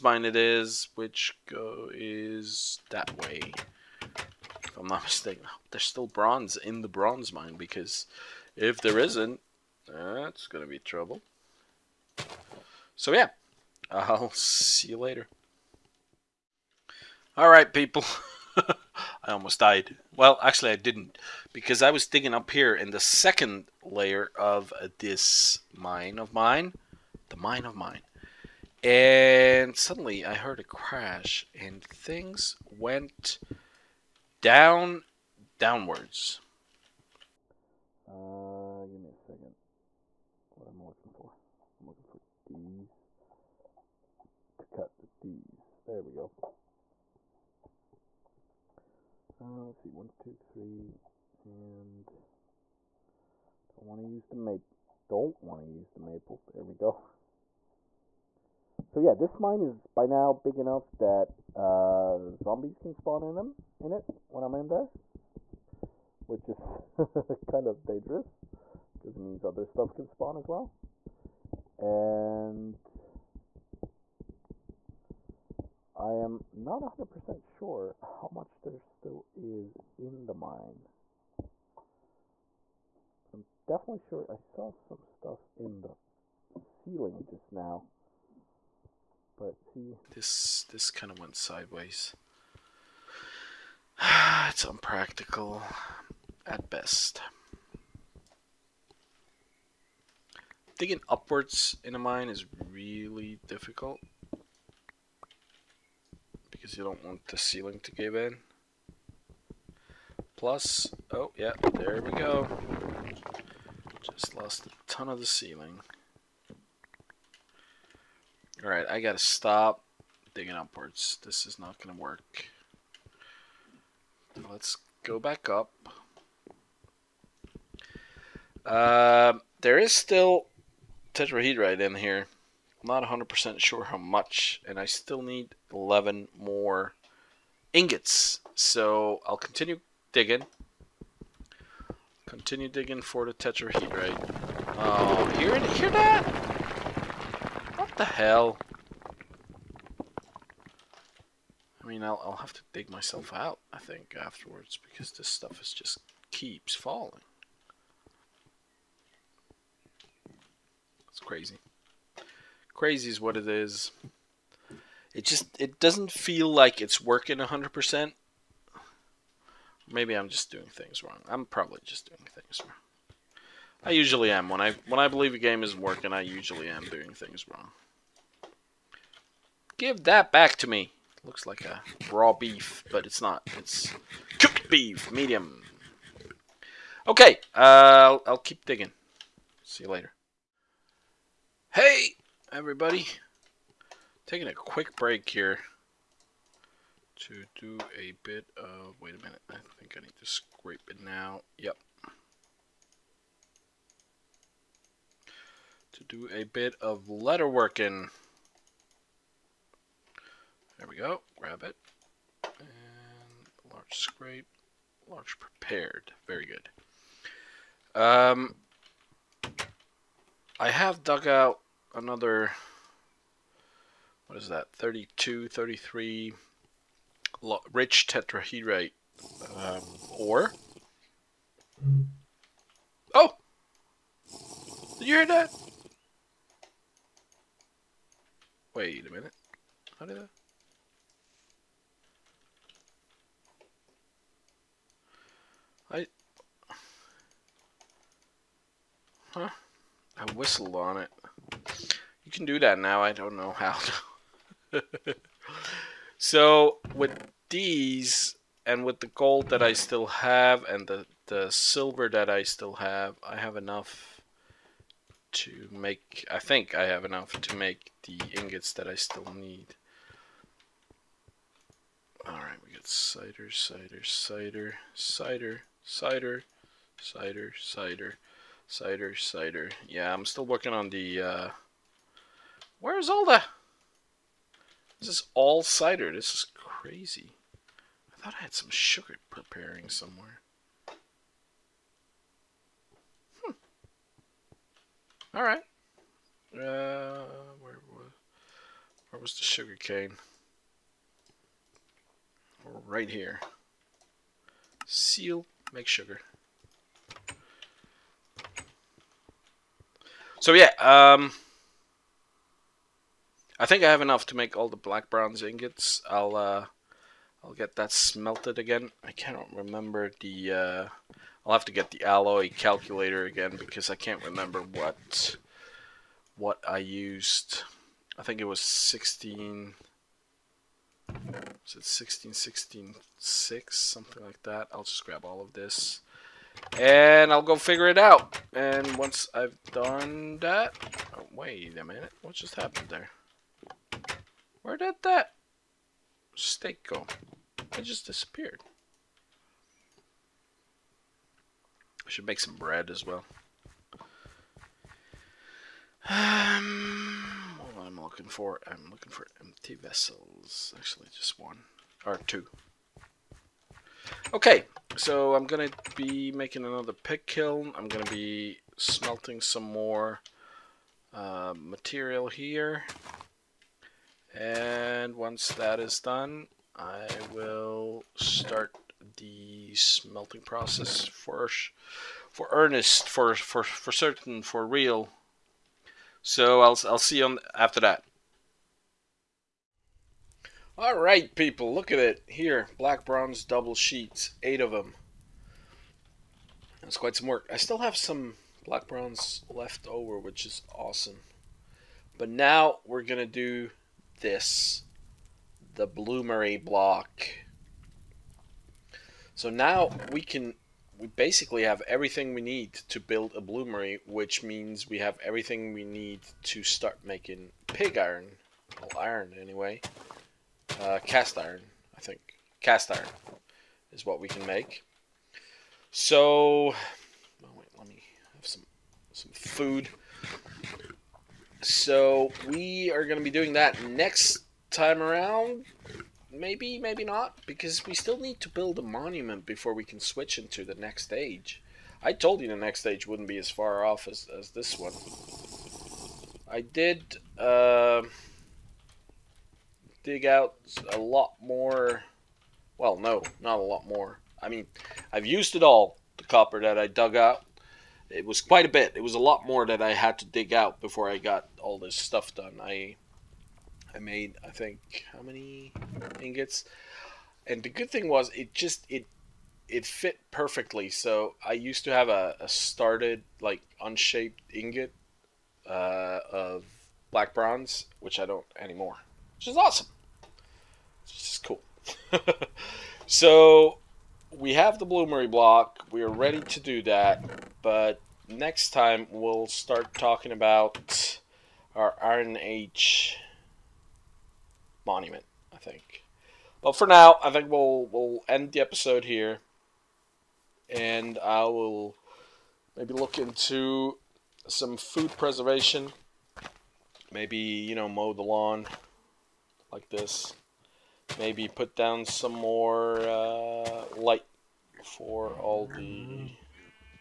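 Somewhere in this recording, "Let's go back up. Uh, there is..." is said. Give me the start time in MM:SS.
02:04.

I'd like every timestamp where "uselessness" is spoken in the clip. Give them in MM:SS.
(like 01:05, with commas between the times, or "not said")
not said.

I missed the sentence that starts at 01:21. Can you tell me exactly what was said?
But I'm definitely sure I saw some stuff in the ceiling just now.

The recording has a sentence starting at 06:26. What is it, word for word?
So I'll I'll see you on after that.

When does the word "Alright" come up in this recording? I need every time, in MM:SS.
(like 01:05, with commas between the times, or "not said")
00:17, 01:58, 04:32, 04:55.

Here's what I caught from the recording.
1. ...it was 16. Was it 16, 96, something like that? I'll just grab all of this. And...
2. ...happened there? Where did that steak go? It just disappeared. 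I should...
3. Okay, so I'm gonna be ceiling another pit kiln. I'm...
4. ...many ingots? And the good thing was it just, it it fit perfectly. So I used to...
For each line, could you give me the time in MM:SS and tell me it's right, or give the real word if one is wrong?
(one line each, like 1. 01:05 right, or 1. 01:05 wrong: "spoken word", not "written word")
1. 05:28 wrong: "16", not "96"
2. 05:42 right
3. 06:04 wrong: "making", not "ceiling"
4. 07:45 right.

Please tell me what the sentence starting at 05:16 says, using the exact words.
I'll uh, I'll get that smelted again.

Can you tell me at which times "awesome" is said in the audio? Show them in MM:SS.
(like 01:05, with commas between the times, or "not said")
06:40, 07:59.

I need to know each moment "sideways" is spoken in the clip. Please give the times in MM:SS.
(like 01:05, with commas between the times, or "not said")
01:31.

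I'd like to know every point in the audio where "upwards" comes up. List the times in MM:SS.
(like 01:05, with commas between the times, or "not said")
01:41, 02:00.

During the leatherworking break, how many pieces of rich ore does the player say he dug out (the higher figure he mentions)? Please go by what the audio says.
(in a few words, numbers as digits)
33.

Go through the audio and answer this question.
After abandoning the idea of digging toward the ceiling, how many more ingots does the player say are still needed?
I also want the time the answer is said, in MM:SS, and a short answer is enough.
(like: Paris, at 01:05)
11, at 02:15.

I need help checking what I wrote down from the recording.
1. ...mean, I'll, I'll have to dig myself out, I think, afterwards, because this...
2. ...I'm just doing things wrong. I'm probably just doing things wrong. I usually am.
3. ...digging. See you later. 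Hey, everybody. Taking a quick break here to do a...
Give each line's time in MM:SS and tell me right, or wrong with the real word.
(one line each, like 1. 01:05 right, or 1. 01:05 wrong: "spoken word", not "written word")
1. 02:31 right
2. 02:50 right
3. 03:08 right.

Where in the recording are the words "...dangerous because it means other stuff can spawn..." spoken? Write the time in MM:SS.
01:07.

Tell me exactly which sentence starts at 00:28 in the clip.
And suddenly I heard a crash and things went down, downwards.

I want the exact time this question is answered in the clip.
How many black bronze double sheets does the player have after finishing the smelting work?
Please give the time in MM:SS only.
06:34.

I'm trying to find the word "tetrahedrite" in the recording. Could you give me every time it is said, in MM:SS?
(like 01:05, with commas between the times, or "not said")
02:11, 02:23, 03:48.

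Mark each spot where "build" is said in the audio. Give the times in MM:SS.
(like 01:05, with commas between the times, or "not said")
06:52, 07:18.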